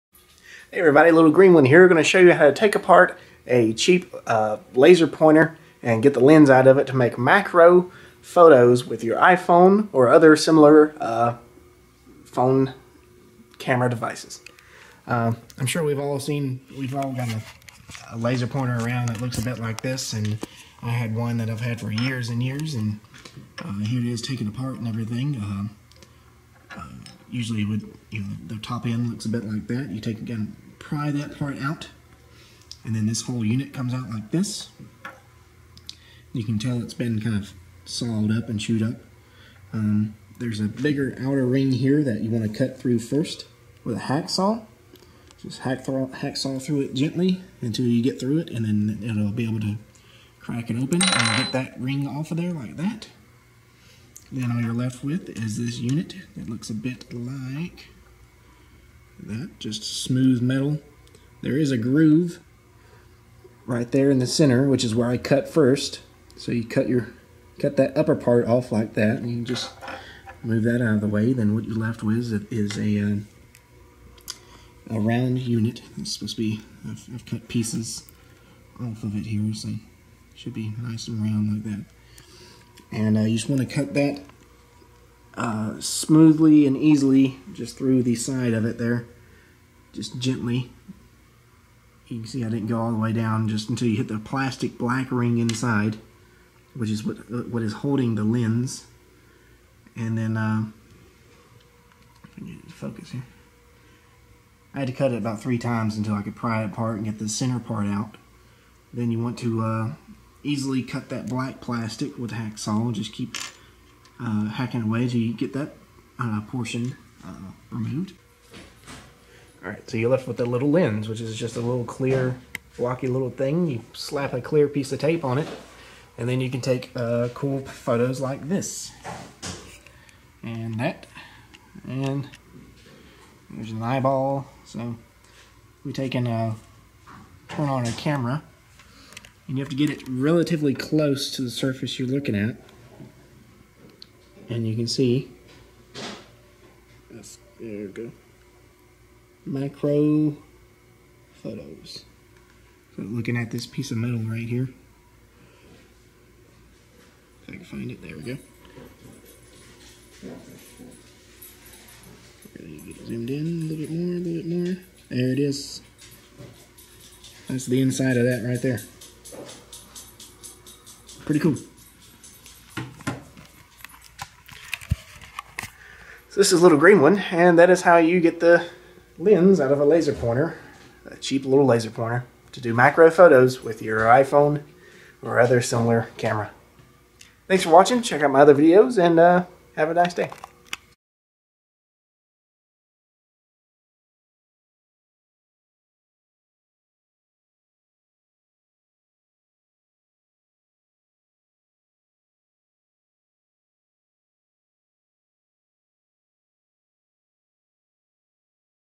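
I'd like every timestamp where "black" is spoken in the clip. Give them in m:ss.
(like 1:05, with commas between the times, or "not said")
1:34, 1:51.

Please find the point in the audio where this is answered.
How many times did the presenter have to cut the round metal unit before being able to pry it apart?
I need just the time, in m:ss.
1:45.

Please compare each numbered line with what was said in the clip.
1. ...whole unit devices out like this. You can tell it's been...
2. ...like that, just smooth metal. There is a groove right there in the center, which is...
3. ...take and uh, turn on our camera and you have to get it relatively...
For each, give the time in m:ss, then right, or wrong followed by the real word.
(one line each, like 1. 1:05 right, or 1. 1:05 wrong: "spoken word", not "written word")
1. 0:33 wrong: "comes", not "devices"
2. 0:57 right
3. 2:15 right.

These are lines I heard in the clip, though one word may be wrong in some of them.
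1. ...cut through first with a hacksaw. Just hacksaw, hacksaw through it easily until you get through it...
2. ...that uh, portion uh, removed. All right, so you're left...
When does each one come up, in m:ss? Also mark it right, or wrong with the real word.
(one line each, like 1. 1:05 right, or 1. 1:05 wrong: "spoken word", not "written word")
1. 0:42 wrong: "gently", not "easily"
2. 1:55 right.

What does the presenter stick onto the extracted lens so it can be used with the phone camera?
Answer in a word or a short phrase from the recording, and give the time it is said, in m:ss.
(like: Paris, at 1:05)
clear piece of tape, at 2:04.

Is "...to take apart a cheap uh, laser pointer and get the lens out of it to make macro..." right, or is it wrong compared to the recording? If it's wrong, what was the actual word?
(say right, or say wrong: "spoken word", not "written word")
right.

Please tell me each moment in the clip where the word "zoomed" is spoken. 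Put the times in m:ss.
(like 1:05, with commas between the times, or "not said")
2:43.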